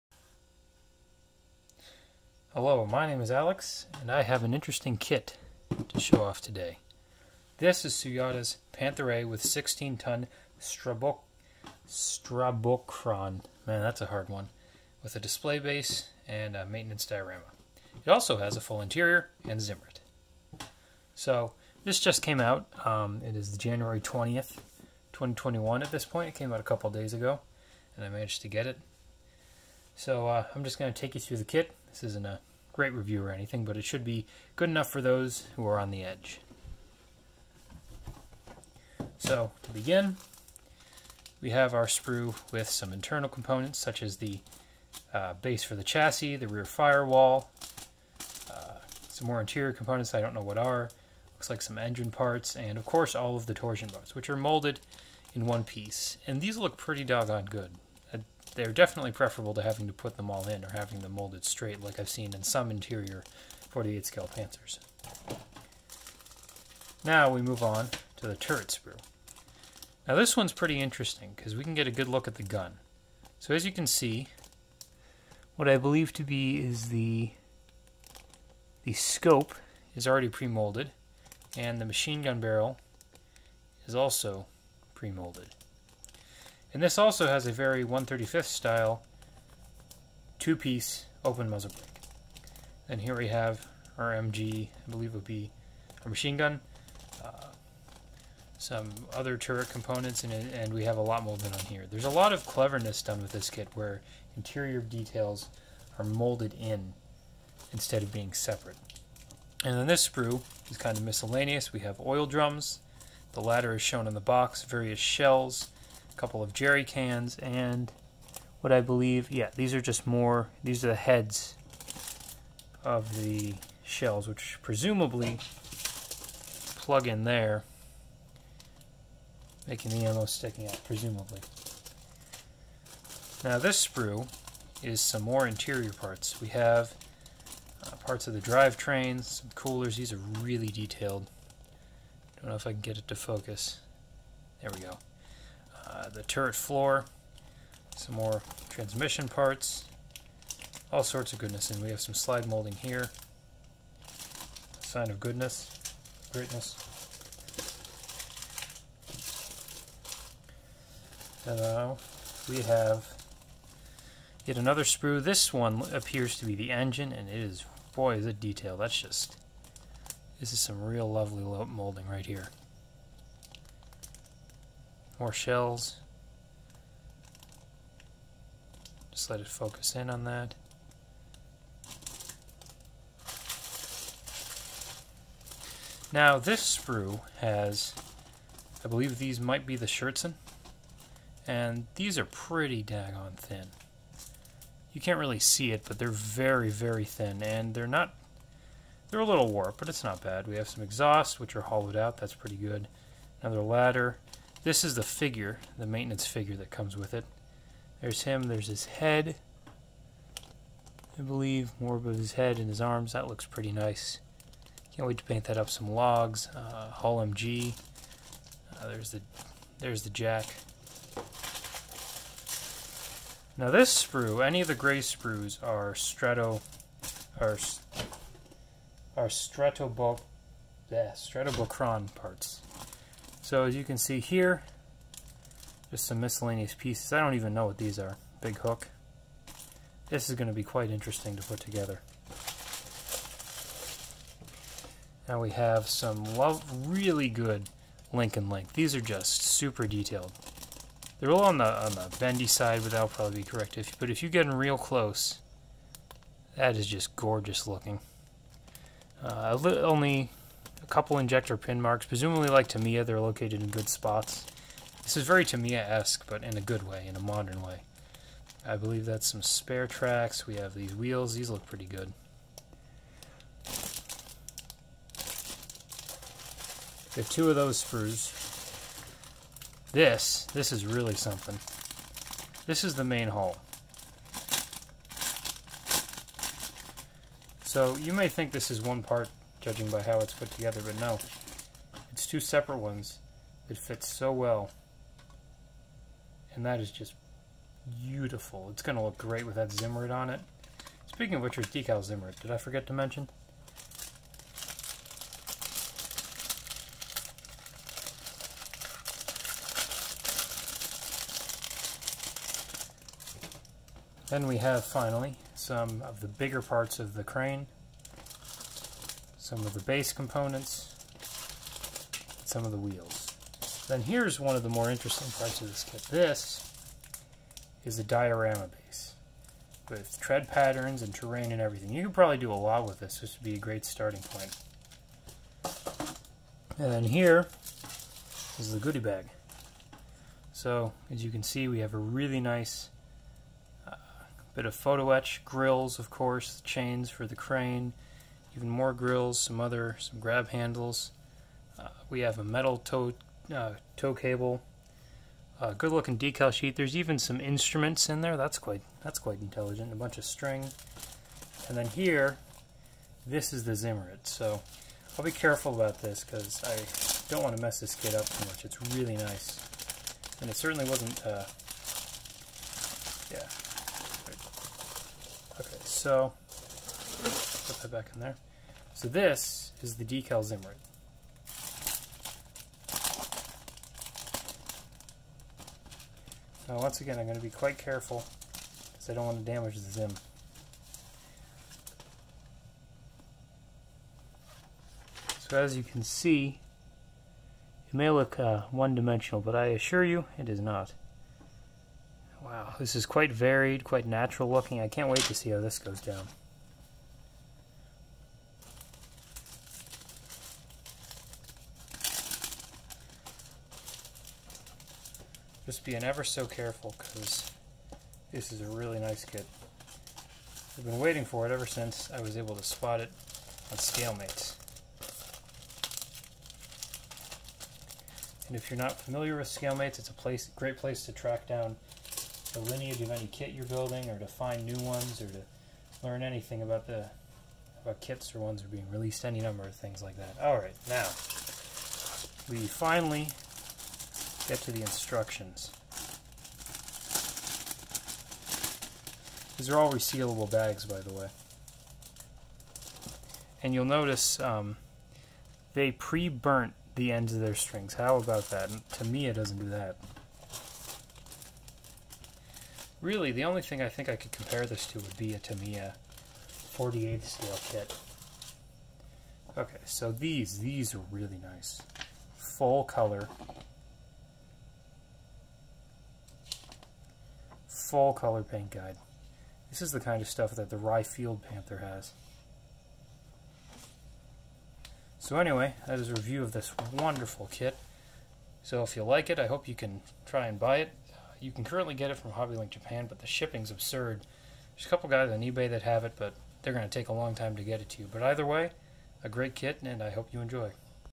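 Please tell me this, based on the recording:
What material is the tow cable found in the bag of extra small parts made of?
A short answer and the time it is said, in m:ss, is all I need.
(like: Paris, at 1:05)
metal, at 5:52.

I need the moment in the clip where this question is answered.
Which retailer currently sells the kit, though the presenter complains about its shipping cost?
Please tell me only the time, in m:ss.
8:12.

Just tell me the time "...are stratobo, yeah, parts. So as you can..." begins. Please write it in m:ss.
3:49.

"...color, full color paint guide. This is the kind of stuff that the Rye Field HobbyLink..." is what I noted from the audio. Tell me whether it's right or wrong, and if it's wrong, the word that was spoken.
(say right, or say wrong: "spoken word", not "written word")
wrong: "Panther", not "HobbyLink".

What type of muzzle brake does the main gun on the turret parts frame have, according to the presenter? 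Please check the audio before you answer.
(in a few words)
two-piece open muzzle brake.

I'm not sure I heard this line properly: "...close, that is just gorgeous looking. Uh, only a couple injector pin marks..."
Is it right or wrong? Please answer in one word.
right.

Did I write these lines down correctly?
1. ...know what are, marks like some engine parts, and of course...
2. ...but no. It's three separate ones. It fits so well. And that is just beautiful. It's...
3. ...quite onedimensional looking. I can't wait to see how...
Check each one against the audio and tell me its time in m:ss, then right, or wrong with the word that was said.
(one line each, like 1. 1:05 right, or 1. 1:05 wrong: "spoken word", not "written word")
1. 0:50 wrong: "looks", not "marks"
2. 4:50 wrong: "two", not "three"
3. 6:43 wrong: "natural", not "onedimensional".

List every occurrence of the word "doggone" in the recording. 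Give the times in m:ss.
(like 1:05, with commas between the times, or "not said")
0:57.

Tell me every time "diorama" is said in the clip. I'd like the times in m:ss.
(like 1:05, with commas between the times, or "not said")
0:17, 5:28.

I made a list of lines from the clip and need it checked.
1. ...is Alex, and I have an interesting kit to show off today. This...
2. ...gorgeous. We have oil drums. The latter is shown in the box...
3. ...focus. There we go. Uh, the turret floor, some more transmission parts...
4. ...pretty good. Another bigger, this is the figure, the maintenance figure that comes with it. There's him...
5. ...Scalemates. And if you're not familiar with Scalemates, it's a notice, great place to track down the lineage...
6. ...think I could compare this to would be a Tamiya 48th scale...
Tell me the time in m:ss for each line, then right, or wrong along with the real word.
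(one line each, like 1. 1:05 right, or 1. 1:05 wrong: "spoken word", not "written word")
1. 0:03 right
2. 1:51 wrong: "miscellaneous", not "gorgeous"
3. 2:23 right
4. 3:22 wrong: "ladder", not "bigger"
5. 7:03 wrong: "place", not "notice"
6. 7:43 right.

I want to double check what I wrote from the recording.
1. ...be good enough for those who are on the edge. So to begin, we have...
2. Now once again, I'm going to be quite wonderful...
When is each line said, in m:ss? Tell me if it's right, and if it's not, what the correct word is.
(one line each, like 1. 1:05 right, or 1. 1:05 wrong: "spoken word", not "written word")
1. 0:34 right
2. 6:26 wrong: "careful", not "wonderful".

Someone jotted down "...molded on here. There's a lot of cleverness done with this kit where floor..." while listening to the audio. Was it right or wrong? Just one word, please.
wrong.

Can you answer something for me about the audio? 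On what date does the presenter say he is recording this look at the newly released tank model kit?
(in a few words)
January 20th, 2021.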